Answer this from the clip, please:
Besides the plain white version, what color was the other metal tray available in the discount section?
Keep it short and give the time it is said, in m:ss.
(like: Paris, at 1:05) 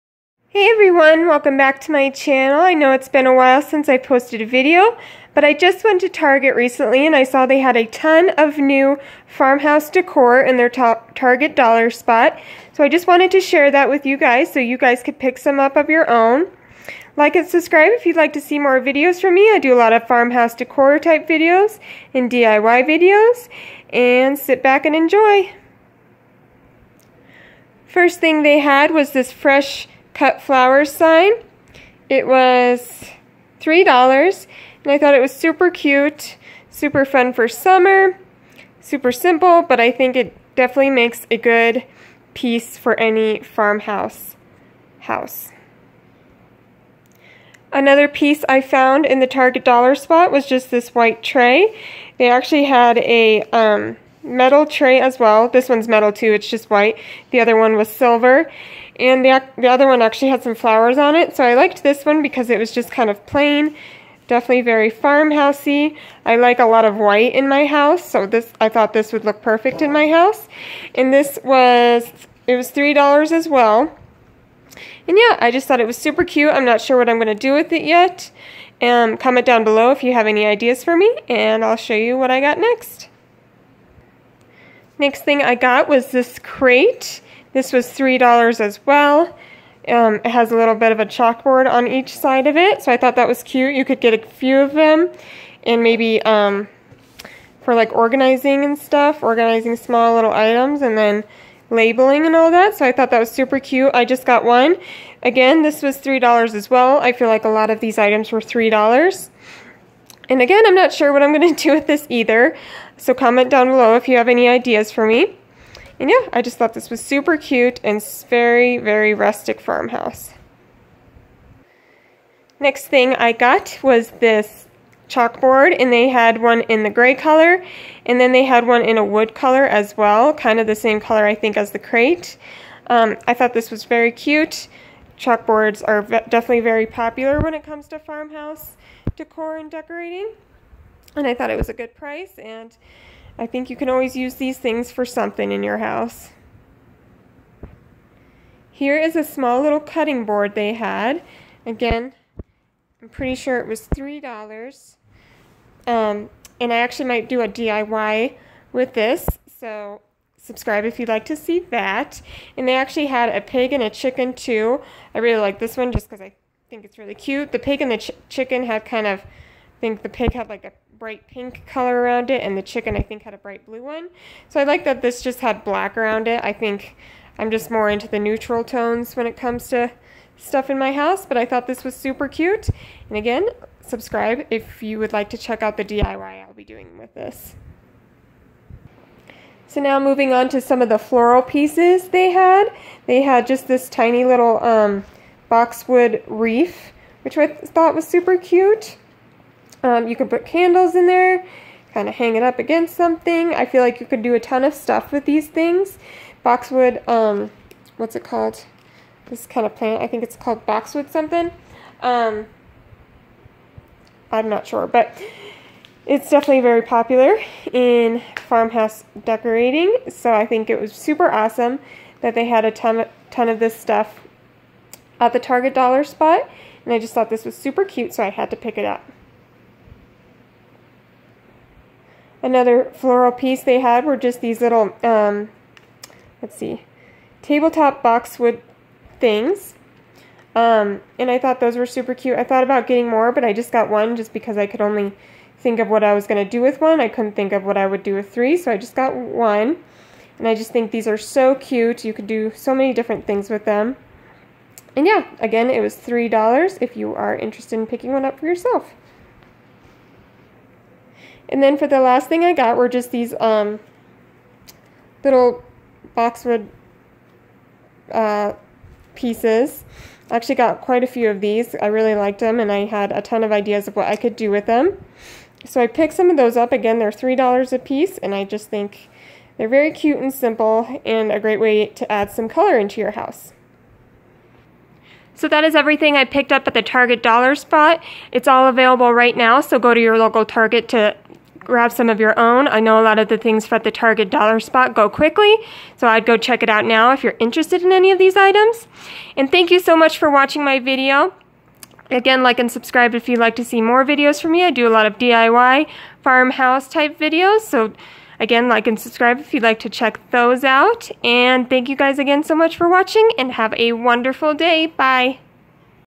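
Silver, at 0:57.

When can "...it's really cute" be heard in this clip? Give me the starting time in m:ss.
2:46.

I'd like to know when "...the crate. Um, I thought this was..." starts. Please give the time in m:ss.
2:11.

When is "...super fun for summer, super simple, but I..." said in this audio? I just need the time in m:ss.
0:36.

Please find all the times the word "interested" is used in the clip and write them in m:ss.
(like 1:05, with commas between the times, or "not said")
4:17, 4:57.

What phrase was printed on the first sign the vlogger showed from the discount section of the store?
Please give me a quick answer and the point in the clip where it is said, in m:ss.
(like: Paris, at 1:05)
Fresh cut flowers, at 0:29.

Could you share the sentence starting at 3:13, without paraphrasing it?
They had just this tiny little um, boxwood wreath, which I thought was super cute.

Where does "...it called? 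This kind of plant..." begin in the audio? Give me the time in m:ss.
3:28.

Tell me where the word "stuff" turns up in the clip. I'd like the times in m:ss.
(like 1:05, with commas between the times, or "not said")
1:38, 3:00, 3:24, 3:43.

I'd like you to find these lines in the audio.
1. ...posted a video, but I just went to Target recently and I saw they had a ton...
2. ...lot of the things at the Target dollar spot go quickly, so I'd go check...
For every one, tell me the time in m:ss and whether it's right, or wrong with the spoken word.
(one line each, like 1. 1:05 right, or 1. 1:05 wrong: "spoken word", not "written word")
1. 0:03 right
2. 4:53 right.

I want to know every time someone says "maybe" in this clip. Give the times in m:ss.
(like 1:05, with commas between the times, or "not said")
1:35.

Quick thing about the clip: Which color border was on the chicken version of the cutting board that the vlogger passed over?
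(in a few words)
Bright blue.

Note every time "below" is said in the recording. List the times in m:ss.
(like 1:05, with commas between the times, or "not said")
1:19, 1:53.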